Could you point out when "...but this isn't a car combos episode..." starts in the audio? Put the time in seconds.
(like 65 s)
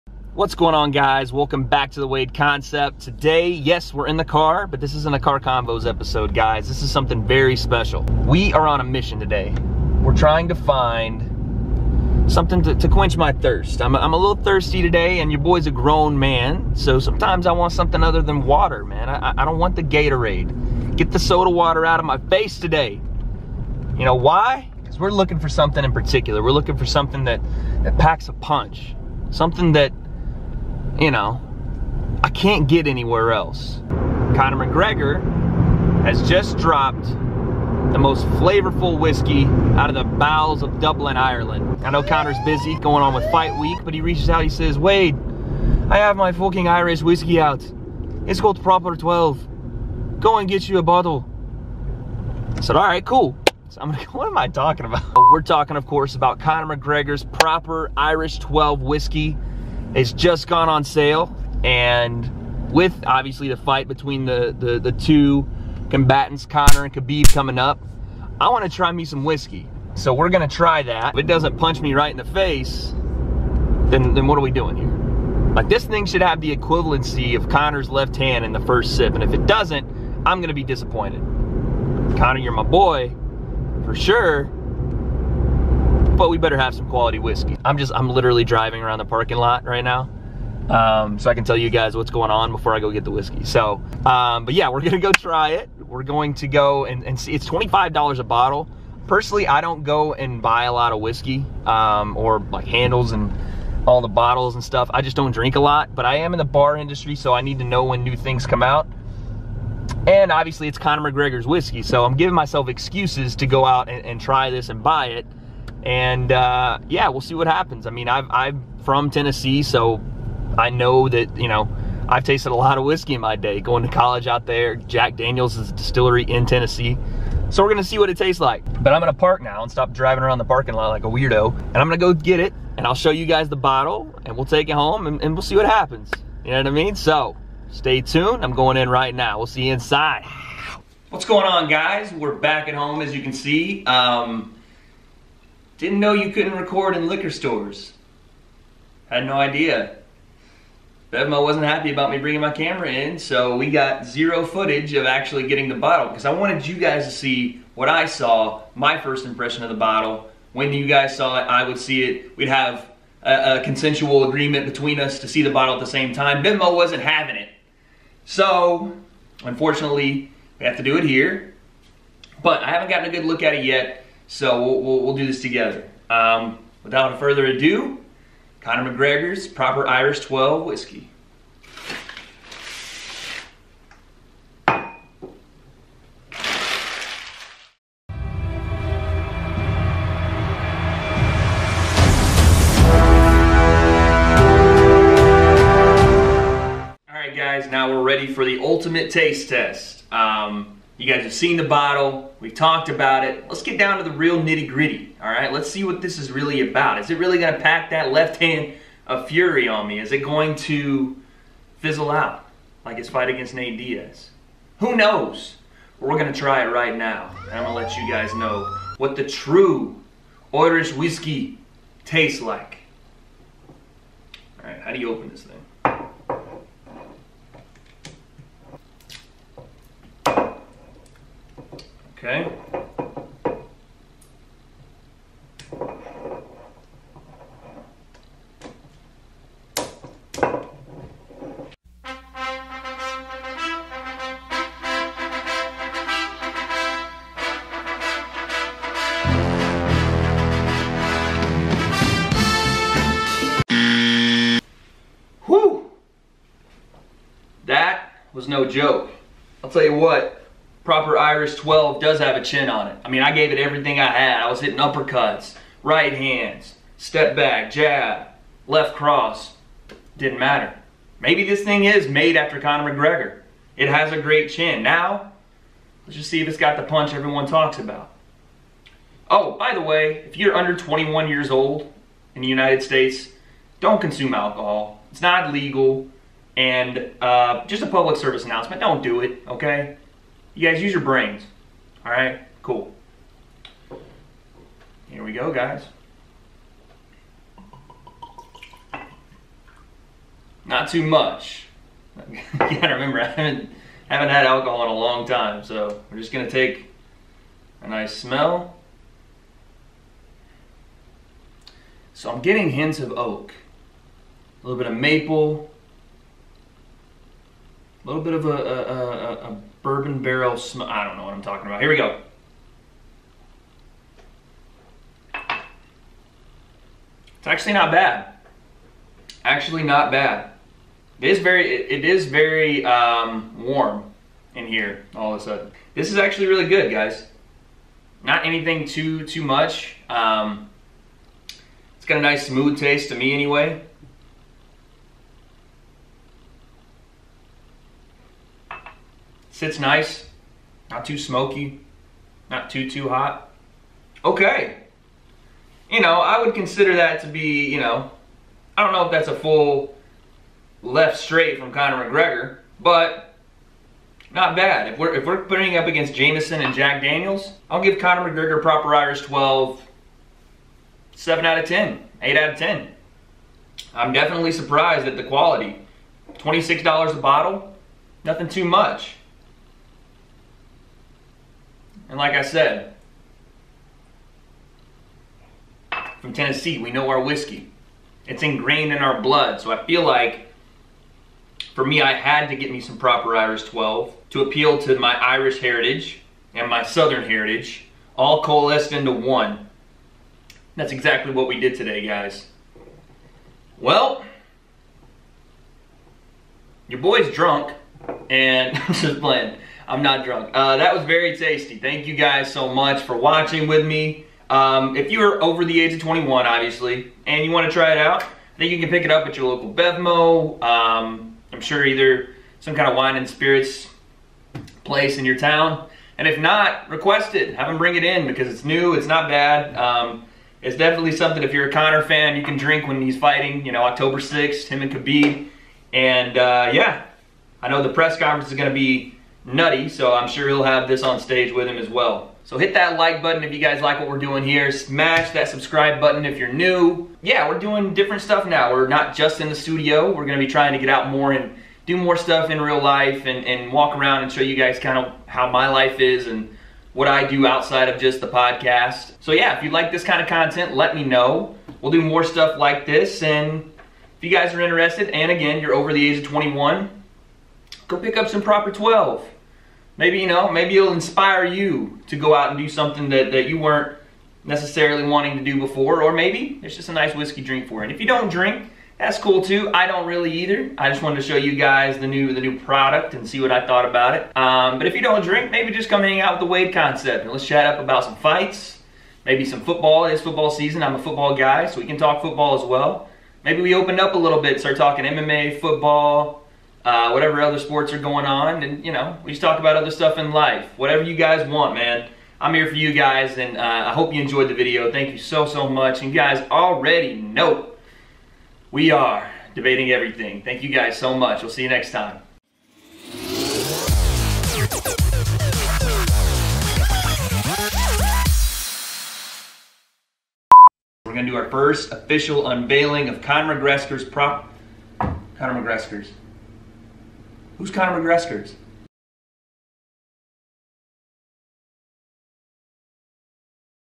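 4 s.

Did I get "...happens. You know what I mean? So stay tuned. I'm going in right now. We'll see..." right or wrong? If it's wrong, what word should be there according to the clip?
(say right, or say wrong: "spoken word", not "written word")
right.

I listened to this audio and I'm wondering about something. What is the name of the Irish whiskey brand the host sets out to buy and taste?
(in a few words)
Proper 12.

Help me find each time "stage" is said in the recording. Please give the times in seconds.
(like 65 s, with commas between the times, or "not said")
441 s.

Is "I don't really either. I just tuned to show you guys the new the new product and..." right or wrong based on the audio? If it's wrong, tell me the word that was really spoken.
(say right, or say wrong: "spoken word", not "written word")
wrong: "wanted", not "tuned".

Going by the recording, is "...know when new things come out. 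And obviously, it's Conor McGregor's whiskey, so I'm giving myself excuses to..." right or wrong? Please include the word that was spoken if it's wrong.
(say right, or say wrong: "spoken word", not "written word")
right.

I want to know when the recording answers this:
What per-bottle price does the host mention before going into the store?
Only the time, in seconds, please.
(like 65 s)
97 s.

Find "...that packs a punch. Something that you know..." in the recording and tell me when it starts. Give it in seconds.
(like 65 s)
27 s.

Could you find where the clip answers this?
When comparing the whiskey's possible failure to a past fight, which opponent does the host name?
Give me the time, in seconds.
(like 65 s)
213 s.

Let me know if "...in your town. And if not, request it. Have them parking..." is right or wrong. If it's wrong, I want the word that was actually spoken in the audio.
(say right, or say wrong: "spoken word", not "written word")
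wrong: "bring", not "parking".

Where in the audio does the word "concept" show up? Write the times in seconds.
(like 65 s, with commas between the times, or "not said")
2 s, 486 s.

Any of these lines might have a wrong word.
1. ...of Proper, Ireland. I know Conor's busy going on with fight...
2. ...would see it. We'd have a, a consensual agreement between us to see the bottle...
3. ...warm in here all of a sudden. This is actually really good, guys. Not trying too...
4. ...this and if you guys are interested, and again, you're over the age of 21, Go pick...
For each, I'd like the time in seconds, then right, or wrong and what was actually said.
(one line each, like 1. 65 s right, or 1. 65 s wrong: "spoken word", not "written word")
1. 40 s wrong: "Dublin", not "Proper"
2. 161 s right
3. 333 s wrong: "anything", not "trying"
4. 462 s right.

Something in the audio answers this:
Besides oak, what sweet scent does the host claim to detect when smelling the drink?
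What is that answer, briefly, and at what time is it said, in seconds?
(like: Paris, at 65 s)
maple, at 314 s.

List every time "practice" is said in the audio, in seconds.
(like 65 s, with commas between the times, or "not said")
not said.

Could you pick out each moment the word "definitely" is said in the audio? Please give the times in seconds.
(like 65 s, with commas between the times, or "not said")
374 s, 430 s.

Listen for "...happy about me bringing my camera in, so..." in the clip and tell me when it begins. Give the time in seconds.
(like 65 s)
151 s.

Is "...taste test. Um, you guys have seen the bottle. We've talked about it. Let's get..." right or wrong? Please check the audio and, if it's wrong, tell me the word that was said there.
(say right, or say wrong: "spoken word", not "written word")
right.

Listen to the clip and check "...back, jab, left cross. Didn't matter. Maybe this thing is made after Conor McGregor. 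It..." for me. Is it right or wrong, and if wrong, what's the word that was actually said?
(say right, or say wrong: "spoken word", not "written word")
right.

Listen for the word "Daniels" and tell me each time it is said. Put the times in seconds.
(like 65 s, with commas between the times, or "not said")
125 s, 367 s.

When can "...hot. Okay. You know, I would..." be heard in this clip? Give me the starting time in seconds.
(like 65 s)
353 s.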